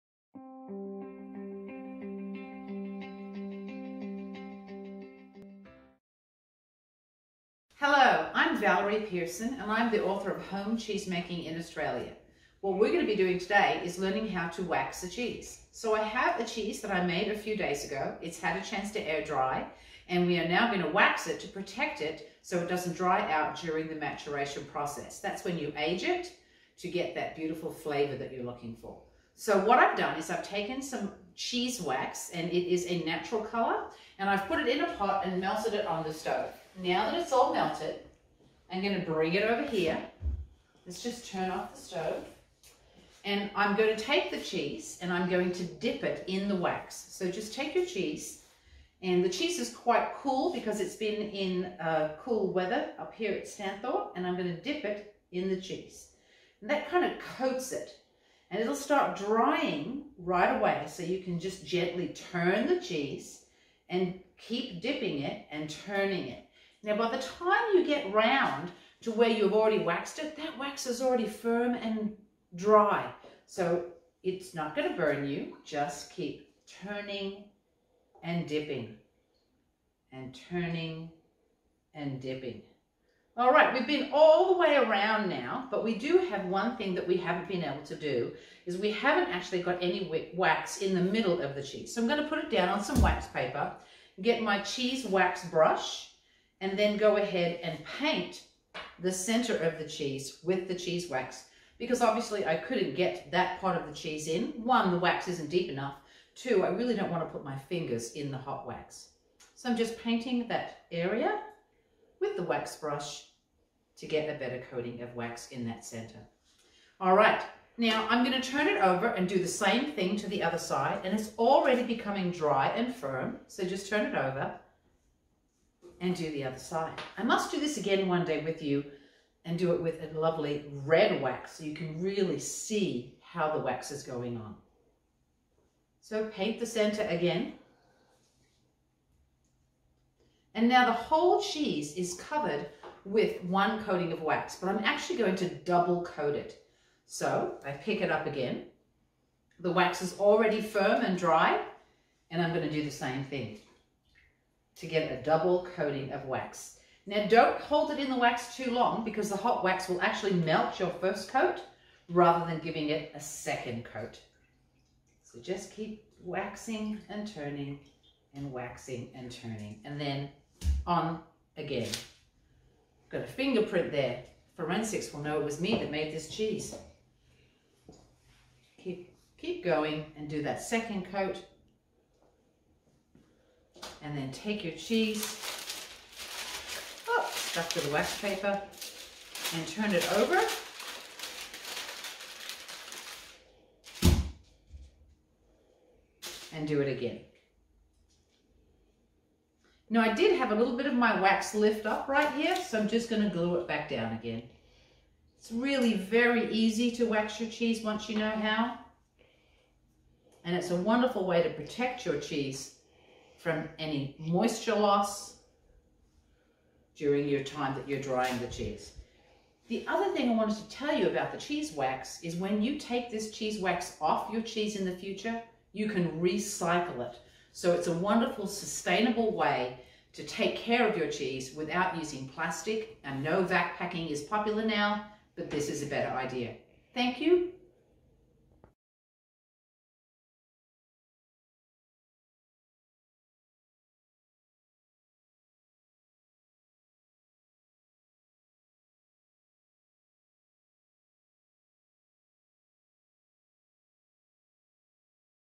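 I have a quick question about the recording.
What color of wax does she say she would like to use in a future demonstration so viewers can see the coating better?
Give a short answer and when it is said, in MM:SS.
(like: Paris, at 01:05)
red, at 02:10.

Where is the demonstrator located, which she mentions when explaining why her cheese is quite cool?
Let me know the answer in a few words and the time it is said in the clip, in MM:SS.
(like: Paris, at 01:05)
Stanthorpe, at 00:53.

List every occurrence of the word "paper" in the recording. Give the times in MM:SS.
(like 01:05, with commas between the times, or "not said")
01:33, 03:08.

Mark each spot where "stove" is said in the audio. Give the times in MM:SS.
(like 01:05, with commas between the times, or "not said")
00:36, 00:41.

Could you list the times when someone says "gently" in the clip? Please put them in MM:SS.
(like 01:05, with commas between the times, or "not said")
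01:01.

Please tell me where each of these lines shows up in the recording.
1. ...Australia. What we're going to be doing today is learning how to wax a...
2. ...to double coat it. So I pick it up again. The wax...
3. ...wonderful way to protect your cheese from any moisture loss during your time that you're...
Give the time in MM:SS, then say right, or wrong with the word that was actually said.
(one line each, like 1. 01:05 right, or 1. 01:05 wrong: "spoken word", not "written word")
1. 00:11 right
2. 02:25 right
3. 03:30 right.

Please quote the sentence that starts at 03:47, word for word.
So it's a wonderful, sustainable way to take care of your cheese without using plastic.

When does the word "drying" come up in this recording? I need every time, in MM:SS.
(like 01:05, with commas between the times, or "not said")
00:59, 03:37.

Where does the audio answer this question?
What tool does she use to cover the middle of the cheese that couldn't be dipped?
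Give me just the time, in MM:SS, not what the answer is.
01:34.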